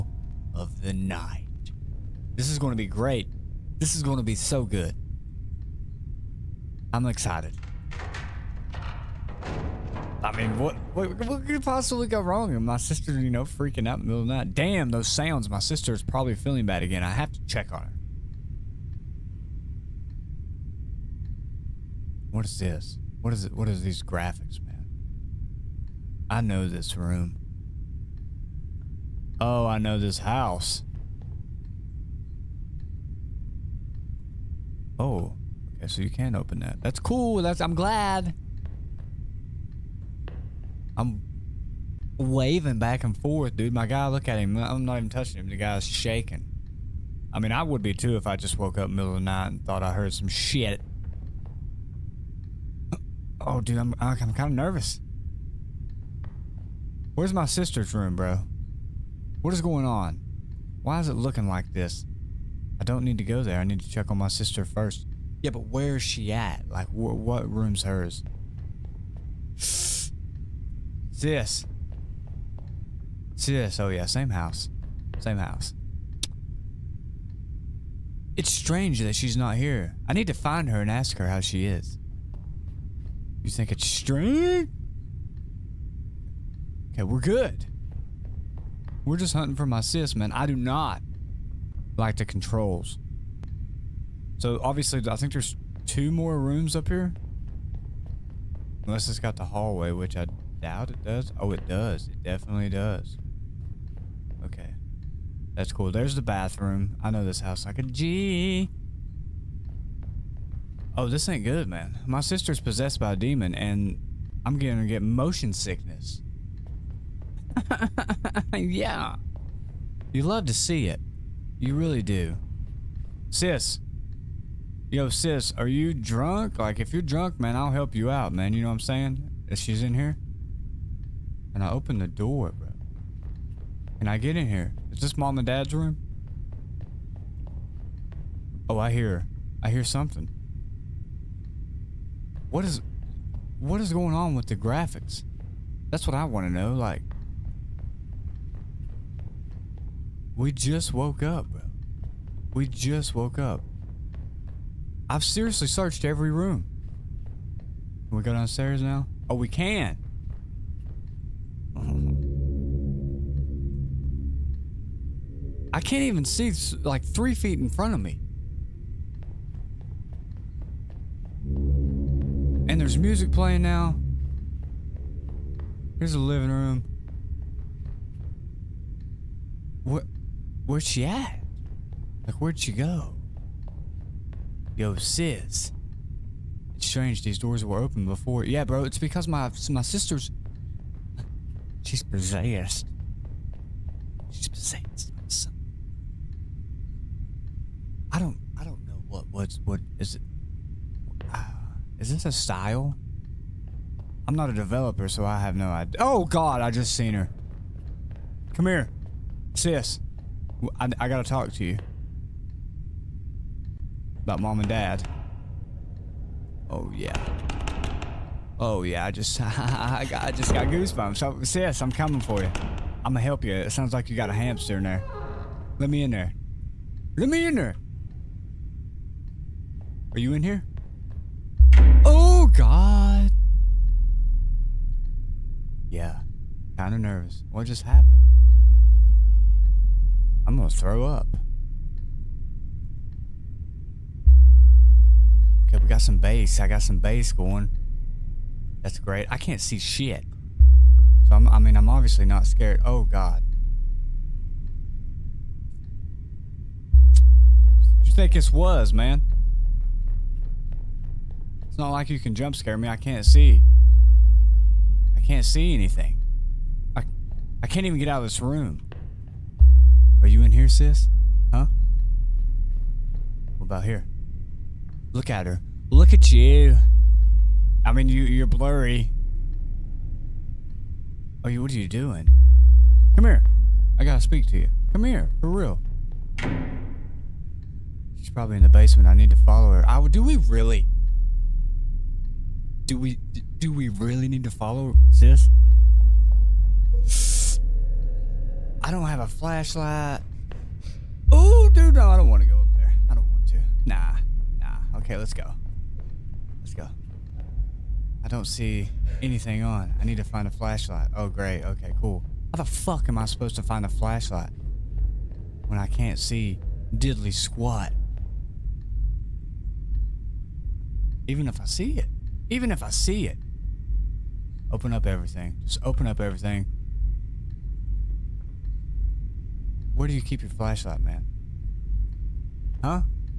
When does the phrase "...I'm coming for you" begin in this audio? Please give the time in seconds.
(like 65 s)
221 s.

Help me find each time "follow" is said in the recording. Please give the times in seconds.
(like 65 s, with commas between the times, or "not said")
289 s, 294 s.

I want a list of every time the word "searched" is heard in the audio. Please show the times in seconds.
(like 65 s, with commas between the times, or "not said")
155 s.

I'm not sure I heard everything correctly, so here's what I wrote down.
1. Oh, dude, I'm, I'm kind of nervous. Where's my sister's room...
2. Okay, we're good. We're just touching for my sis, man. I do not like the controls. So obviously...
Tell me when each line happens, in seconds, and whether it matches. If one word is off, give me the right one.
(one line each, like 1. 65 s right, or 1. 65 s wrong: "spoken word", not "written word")
1. 53 s right
2. 86 s wrong: "hunting", not "touching".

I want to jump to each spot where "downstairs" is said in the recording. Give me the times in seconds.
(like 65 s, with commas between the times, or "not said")
158 s.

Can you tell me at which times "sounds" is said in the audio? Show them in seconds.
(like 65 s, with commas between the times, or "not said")
15 s, 223 s.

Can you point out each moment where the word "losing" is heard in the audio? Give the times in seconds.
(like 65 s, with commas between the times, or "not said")
not said.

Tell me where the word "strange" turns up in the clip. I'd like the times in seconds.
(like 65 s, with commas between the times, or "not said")
78 s, 83 s, 186 s.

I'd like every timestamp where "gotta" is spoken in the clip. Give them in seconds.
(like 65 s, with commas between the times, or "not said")
211 s, 284 s.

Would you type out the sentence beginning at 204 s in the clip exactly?
I'm not a developer, so I have no idea.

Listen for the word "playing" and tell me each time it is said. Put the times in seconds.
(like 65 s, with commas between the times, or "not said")
173 s.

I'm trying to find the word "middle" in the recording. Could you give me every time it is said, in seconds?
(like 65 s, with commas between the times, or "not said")
14 s, 48 s.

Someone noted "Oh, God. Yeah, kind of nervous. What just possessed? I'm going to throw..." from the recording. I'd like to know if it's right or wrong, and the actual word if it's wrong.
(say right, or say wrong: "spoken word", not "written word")
wrong: "happened", not "possessed".